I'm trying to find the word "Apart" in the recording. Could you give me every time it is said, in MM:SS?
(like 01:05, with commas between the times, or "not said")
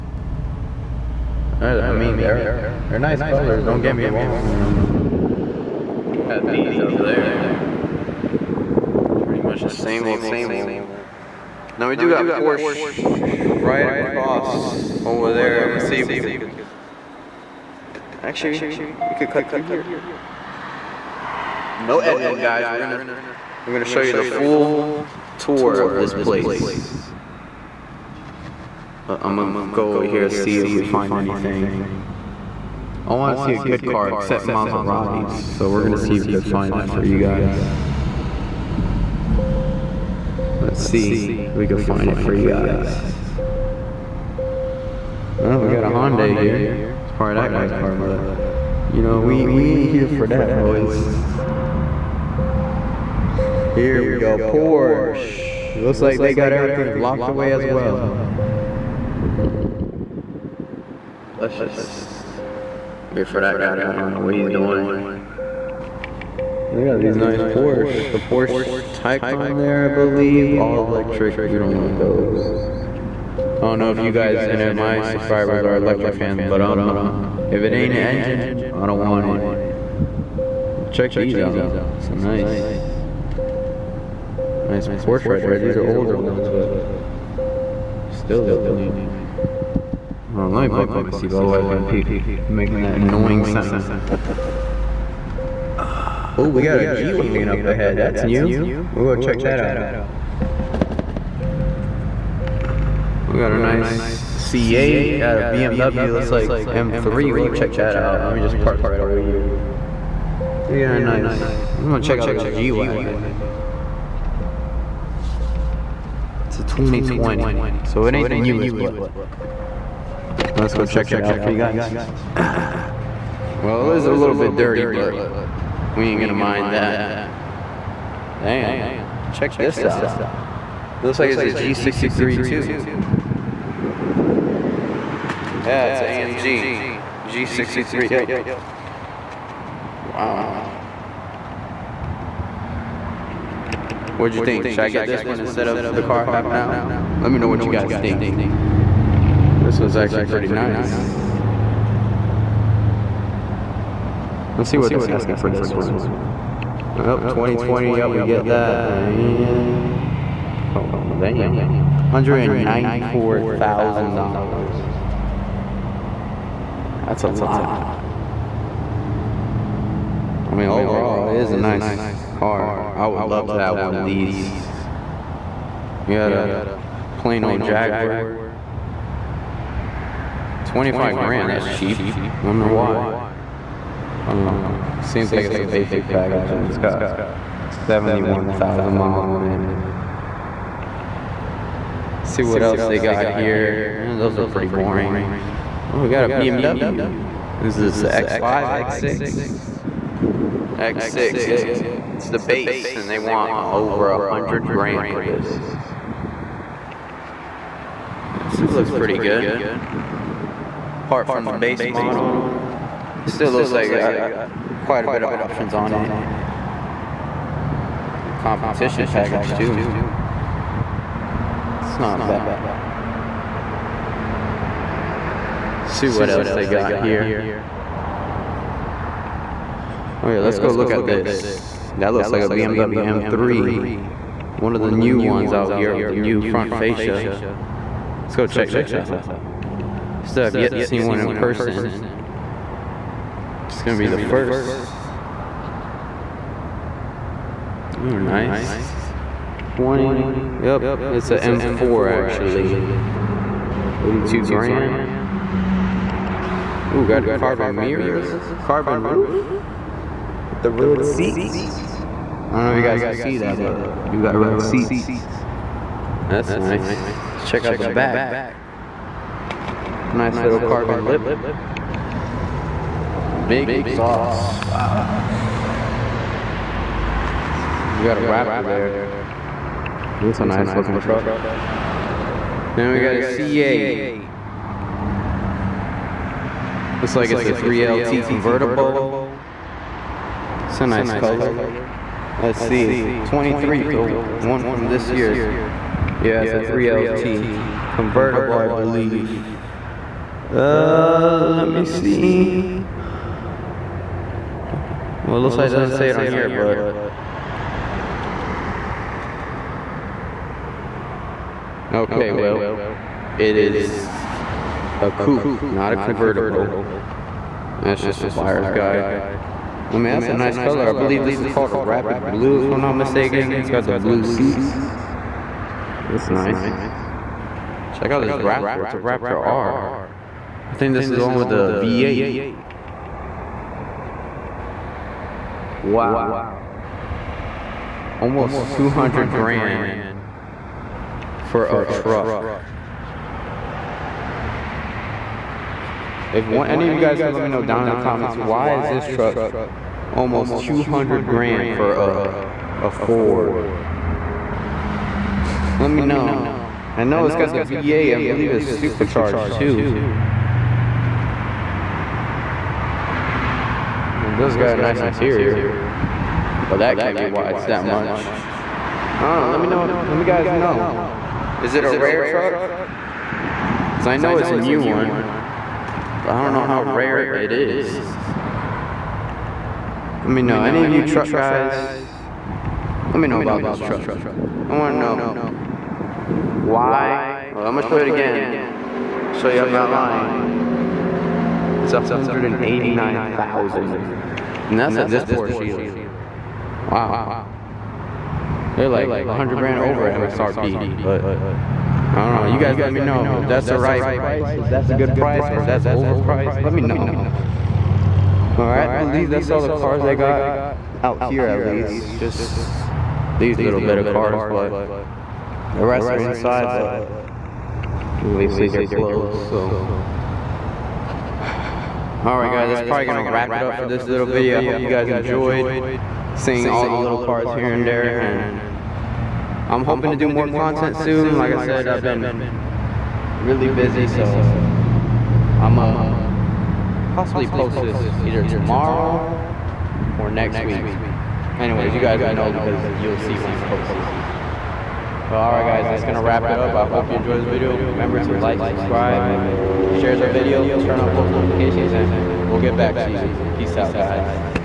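03:31.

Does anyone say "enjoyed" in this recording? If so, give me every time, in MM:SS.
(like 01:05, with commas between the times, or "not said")
07:05, 07:27.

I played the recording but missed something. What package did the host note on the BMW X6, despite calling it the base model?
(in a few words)
competition package.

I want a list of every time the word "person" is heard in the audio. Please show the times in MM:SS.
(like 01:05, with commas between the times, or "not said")
04:01.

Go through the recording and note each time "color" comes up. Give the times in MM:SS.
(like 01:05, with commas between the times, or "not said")
00:03, 04:51, 05:20.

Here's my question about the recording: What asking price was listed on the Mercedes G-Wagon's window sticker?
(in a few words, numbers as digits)
$194,000.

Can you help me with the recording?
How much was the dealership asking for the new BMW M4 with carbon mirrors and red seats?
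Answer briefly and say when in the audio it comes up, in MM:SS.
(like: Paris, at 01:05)
$82,000, at 04:14.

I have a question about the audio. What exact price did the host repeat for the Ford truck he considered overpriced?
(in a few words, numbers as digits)
$189,000.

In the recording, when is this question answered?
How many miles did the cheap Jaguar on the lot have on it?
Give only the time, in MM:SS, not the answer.
03:07.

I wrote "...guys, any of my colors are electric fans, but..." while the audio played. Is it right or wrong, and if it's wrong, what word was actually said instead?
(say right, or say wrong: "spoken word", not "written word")
wrong: "subscribers", not "colors".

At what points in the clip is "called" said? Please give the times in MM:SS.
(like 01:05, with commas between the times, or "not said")
05:21.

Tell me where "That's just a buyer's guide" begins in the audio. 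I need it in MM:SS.
05:17.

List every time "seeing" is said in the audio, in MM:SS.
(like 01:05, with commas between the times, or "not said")
07:06.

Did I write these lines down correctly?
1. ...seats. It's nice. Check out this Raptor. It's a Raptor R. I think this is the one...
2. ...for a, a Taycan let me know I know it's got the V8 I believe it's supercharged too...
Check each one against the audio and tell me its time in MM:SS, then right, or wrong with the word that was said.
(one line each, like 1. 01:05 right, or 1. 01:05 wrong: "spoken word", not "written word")
1. 05:24 right
2. 05:51 wrong: "Ford", not "Taycan".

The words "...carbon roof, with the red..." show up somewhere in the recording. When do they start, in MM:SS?
04:18.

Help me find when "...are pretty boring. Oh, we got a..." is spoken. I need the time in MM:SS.
03:14.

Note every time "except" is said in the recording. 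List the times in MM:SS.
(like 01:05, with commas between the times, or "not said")
00:34.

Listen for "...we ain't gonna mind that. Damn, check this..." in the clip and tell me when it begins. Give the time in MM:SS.
02:05.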